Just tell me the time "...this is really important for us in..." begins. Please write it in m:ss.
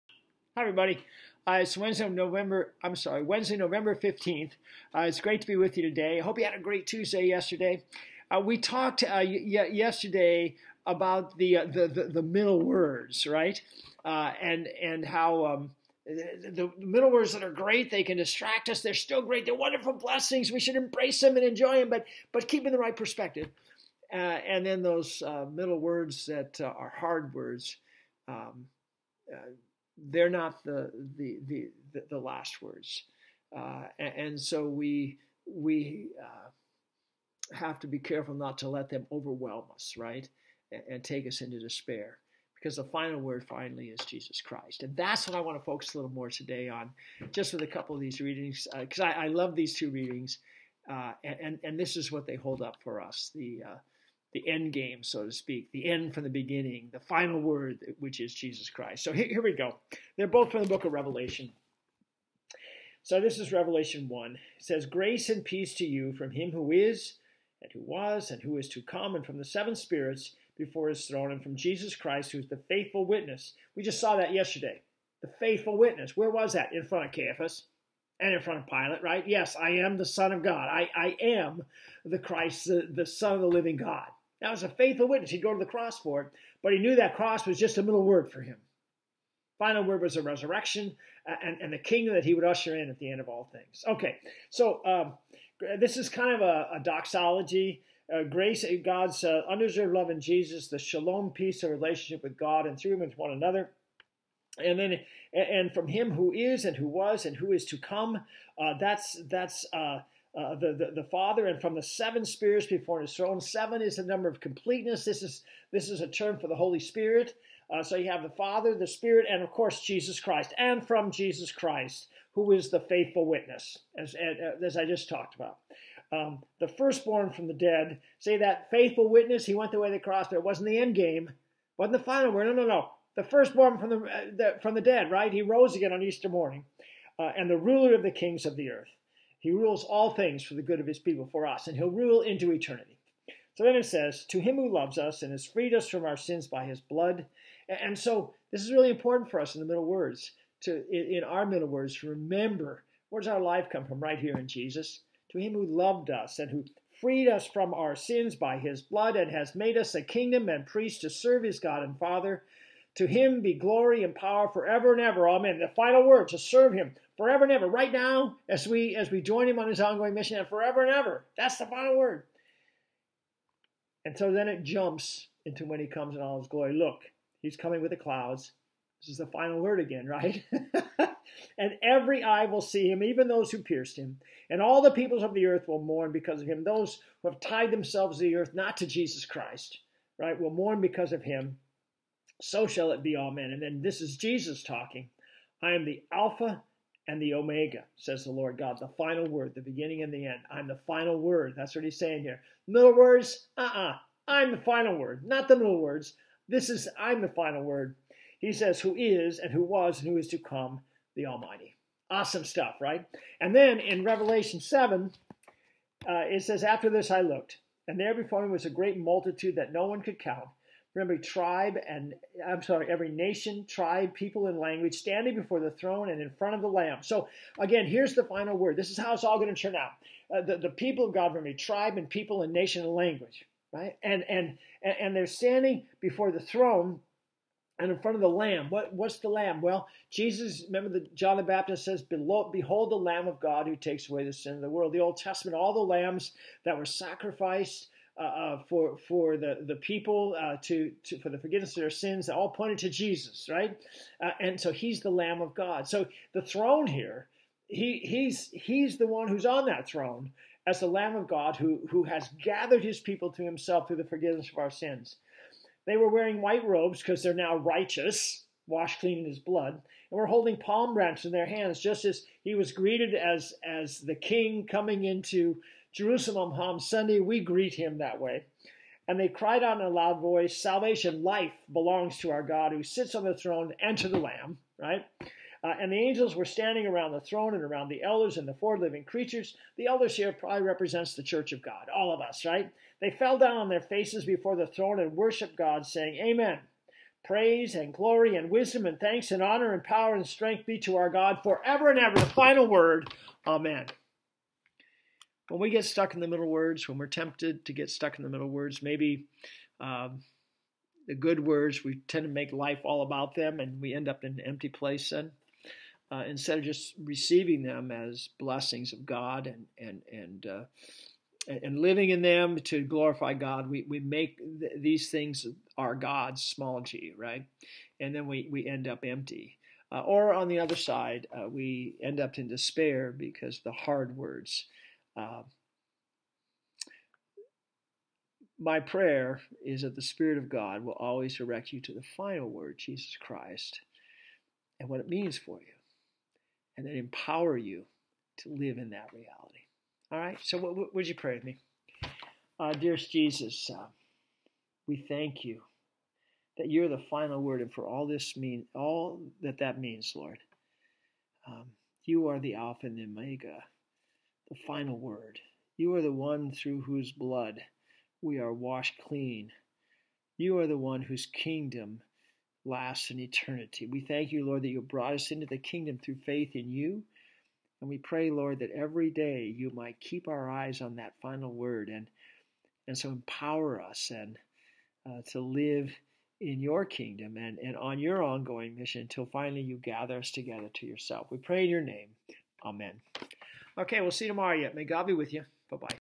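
2:28.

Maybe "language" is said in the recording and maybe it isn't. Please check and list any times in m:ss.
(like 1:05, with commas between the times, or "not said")
3:44, 3:52.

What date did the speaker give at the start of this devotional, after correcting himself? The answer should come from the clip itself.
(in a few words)
Wednesday, November 15th.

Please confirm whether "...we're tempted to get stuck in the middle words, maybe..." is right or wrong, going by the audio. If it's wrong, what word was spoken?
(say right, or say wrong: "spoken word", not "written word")
right.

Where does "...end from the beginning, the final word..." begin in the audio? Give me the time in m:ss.
0:55.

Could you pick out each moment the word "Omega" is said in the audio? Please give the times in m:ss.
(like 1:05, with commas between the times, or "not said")
3:17, 6:03.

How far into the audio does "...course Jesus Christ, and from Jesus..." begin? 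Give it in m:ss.
1:59.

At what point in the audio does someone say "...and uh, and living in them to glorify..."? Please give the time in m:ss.
5:20.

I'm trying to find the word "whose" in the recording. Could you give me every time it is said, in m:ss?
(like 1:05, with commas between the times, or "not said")
6:06, 6:11.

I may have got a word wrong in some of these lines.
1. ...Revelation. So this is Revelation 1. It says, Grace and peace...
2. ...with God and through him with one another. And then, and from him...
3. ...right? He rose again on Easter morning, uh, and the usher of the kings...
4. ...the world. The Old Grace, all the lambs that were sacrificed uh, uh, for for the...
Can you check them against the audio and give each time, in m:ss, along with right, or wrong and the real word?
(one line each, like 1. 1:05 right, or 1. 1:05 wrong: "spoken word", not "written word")
1. 1:00 right
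2. 1:42 right
3. 2:15 wrong: "ruler", not "usher"
4. 4:04 wrong: "Testament", not "Grace".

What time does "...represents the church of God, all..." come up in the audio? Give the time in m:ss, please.
4:50.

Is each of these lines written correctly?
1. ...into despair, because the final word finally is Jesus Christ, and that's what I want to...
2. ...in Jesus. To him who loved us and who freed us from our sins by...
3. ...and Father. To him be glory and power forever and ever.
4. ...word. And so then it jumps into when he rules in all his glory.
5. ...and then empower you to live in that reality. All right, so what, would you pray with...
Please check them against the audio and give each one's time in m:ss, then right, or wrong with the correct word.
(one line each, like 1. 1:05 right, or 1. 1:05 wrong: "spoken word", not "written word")
1. 0:41 right
2. 2:34 right
3. 2:41 right
4. 2:51 wrong: "comes", not "rules"
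5. 5:46 right.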